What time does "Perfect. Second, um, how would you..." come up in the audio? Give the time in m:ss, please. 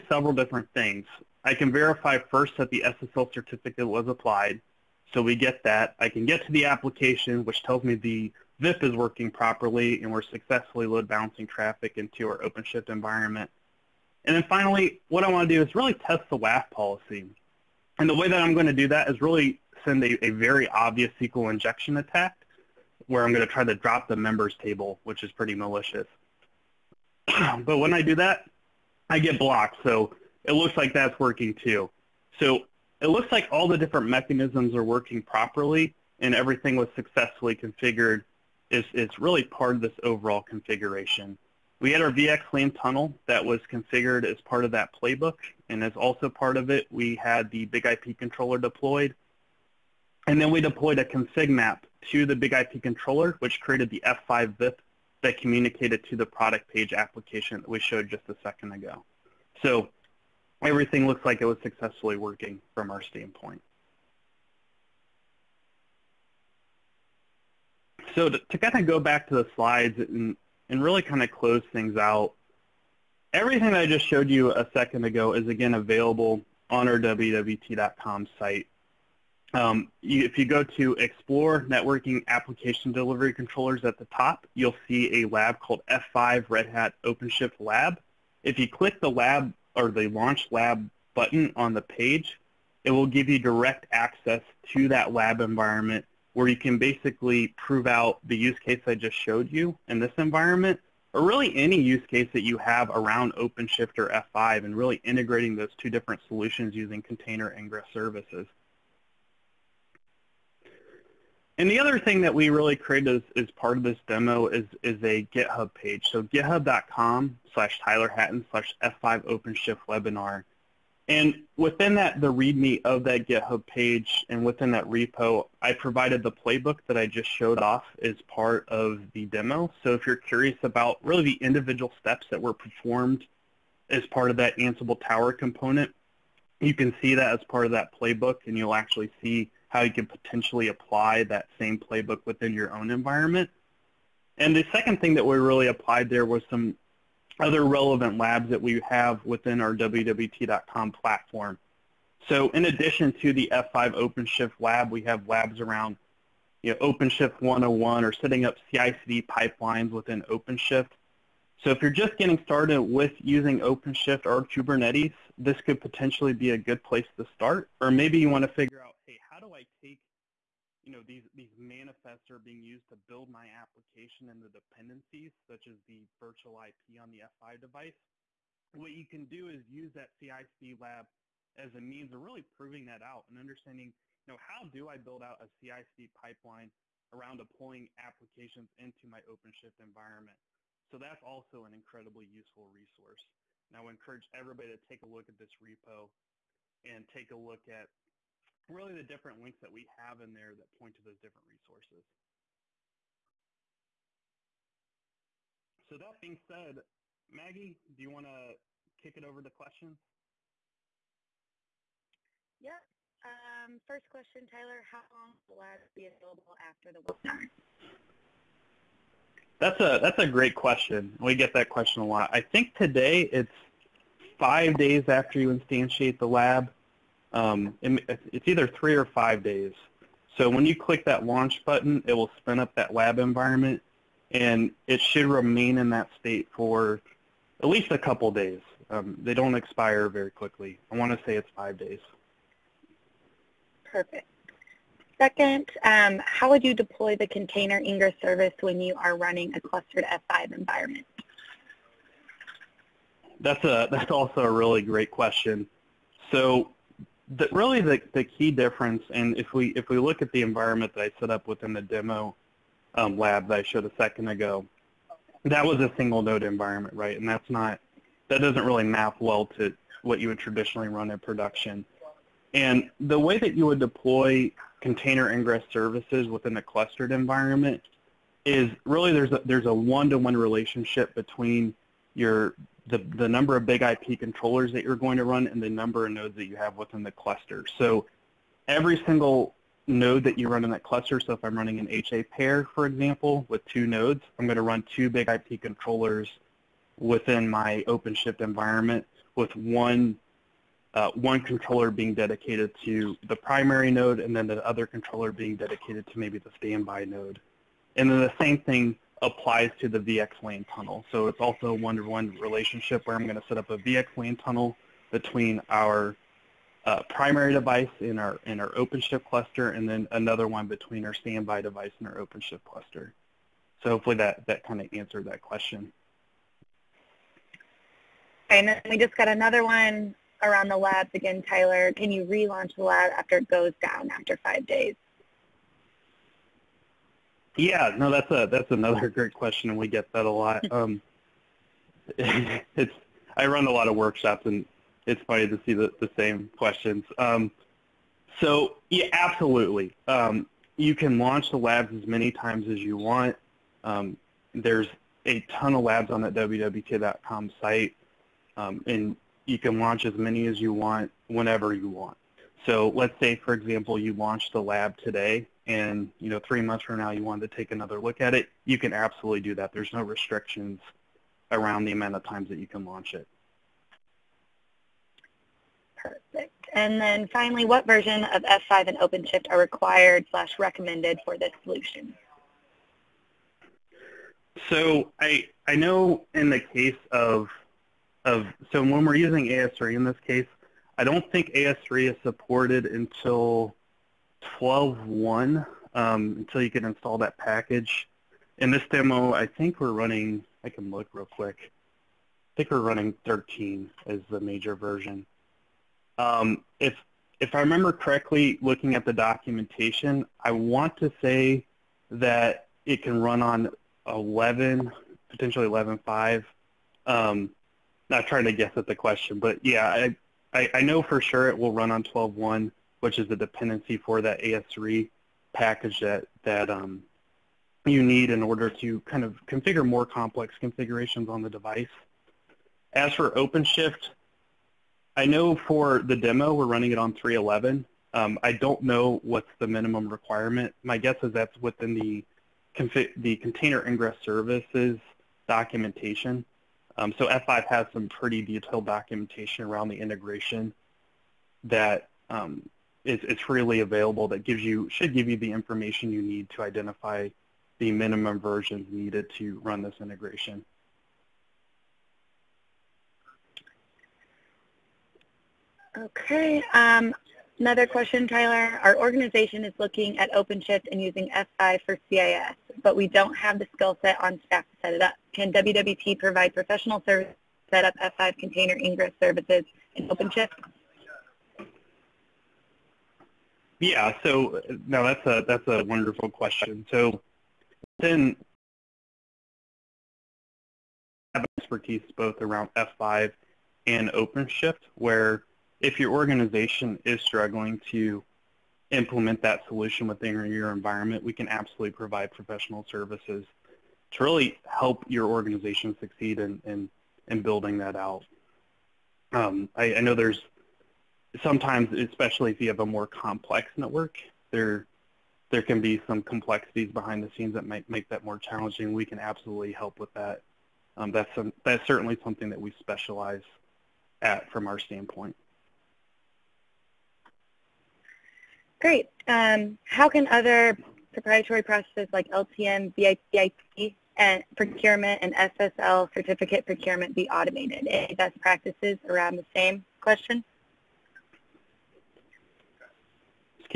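4:03.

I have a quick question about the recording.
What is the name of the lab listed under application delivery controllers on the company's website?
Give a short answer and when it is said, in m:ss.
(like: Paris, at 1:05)
F5 Red Hat OpenShift Lab, at 1:25.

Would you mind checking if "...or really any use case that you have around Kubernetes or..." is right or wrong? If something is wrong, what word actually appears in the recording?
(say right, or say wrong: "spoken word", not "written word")
wrong: "OpenShift", not "Kubernetes".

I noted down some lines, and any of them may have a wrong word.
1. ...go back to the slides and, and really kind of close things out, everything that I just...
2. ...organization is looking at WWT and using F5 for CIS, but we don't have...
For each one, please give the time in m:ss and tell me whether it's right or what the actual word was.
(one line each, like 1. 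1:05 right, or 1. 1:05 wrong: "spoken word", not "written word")
1. 1:08 right
2. 7:48 wrong: "OpenShift", not "WWT".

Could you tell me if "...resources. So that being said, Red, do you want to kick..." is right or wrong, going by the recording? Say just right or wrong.
wrong.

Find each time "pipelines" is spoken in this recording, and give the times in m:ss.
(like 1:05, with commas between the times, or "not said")
2:39, 3:06.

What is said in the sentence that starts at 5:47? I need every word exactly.
Um, so yeah, absolutely, um, you can launch the labs as many times as you want.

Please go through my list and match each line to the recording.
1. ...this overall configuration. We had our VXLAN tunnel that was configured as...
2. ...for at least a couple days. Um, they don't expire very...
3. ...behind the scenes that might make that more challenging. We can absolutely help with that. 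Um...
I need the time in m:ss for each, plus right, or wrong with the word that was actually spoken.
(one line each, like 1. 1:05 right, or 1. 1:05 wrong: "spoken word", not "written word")
1. 0:39 right
2. 3:56 right
3. 8:36 right.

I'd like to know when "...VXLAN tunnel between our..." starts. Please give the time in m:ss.
5:13.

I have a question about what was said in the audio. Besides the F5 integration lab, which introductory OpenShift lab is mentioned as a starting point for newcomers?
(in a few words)
OpenShift 101.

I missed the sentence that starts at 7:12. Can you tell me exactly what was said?
As for OpenShift, I know for the demo we're running it on 3.11.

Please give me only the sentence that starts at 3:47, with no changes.
Um, it's either three or five days.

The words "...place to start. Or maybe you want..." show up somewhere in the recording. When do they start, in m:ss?
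2:46.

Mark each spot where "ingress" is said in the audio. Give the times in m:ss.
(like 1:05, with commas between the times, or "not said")
1:47, 4:07, 4:35, 7:23, 7:58.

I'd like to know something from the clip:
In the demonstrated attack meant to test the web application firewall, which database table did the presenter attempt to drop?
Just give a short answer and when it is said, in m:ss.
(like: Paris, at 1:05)
members, at 0:24.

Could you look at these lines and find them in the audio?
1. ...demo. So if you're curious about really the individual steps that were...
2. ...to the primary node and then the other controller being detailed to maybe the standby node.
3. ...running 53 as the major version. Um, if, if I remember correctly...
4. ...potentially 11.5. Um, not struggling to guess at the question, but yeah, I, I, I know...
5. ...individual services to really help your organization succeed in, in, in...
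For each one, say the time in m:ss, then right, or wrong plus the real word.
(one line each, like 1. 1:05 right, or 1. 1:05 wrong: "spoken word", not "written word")
1. 2:09 right
2. 5:02 wrong: "dedicated", not "detailed"
3. 6:42 wrong: "13", not "53"
4. 6:55 wrong: "trying", not "struggling"
5. 8:22 wrong: "professional", not "individual".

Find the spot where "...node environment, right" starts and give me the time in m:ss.
4:26.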